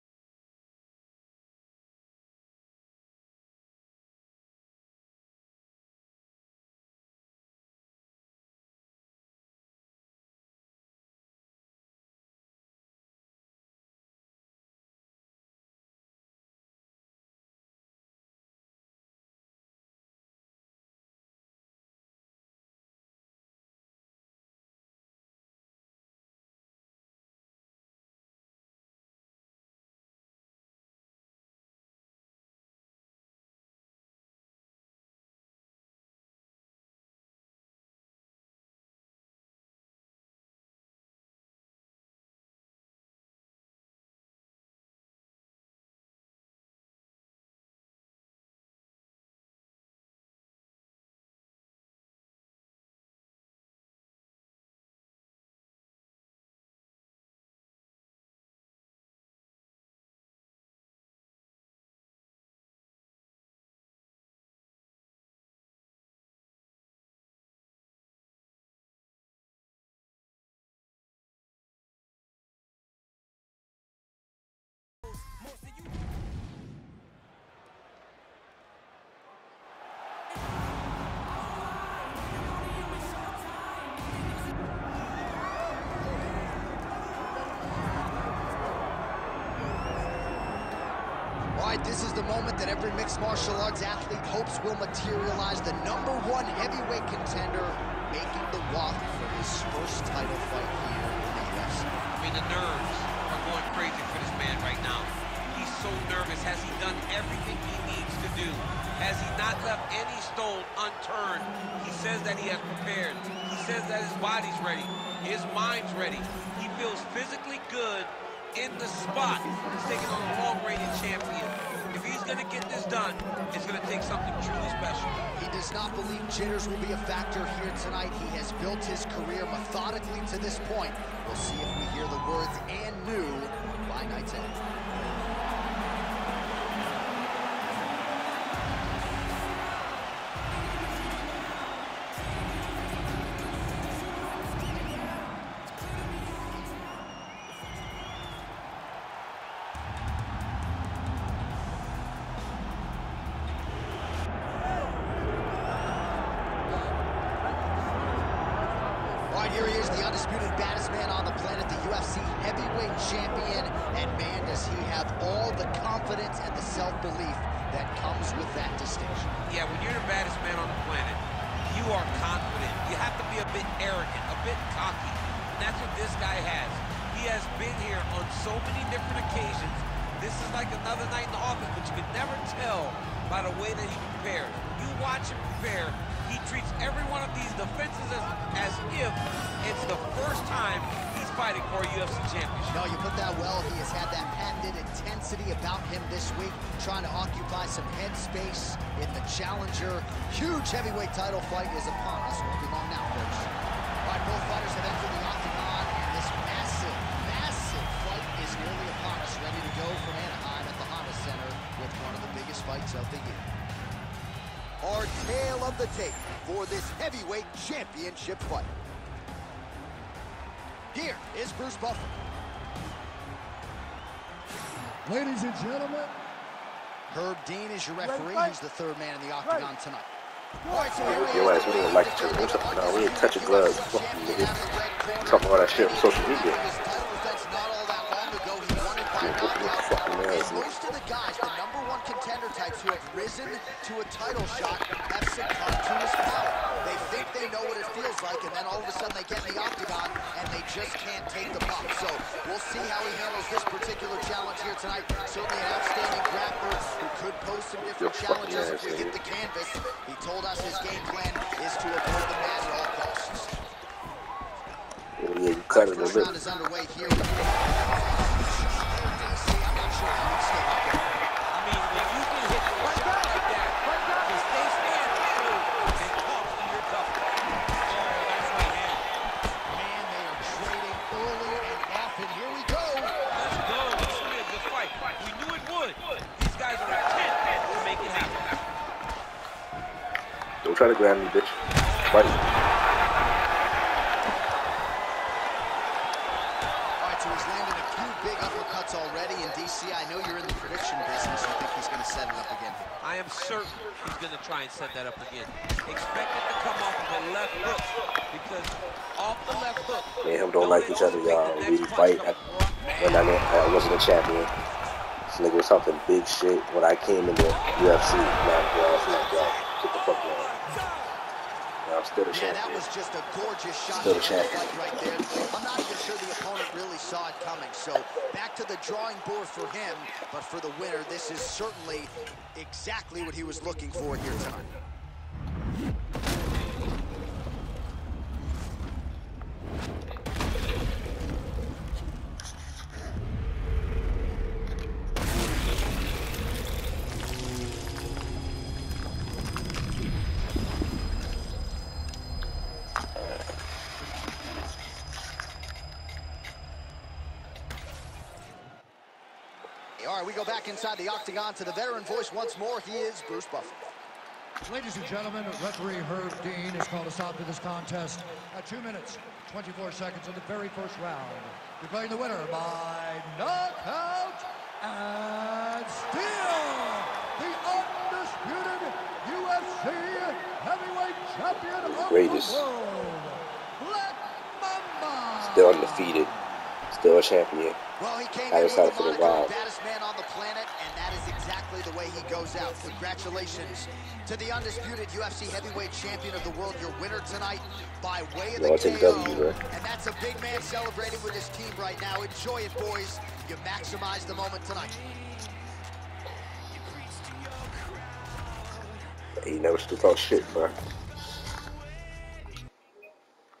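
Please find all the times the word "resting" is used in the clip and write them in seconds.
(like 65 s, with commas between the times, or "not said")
not said.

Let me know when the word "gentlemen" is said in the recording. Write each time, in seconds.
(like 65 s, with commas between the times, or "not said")
225 s, 365 s.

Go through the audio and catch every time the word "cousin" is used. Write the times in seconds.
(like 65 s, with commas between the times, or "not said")
not said.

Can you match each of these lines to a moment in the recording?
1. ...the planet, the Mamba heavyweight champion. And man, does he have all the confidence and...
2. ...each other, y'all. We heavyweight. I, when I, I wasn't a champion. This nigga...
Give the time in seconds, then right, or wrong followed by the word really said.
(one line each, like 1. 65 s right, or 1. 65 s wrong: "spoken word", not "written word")
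1. 161 s wrong: "UFC", not "Mamba"
2. 310 s wrong: "fight", not "heavyweight".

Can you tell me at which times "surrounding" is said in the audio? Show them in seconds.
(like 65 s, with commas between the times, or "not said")
not said.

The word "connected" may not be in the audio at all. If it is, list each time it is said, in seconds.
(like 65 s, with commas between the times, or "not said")
not said.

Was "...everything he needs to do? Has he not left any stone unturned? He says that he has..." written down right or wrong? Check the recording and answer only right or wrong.
right.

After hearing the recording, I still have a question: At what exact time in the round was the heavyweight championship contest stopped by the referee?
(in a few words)
2 minutes, 24 seconds.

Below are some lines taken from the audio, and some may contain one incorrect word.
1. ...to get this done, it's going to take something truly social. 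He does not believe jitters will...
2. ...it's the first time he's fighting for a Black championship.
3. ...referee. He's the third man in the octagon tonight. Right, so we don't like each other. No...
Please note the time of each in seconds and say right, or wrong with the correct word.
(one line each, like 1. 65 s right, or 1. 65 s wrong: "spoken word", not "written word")
1. 122 s wrong: "special", not "social"
2. 189 s wrong: "UFC", not "Black"
3. 227 s right.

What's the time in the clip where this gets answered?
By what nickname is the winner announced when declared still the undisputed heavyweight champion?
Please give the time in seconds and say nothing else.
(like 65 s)
383 s.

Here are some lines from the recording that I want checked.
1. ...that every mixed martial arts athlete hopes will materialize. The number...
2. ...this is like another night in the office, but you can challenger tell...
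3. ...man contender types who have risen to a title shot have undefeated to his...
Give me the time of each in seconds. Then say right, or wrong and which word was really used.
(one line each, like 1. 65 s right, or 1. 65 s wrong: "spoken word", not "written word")
1. 92 s right
2. 180 s wrong: "never", not "challenger"
3. 241 s wrong: "succumbed", not "undefeated".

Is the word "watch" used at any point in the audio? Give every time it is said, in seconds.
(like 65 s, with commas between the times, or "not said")
185 s.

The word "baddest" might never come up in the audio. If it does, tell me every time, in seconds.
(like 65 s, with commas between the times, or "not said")
160 s, 170 s, 389 s.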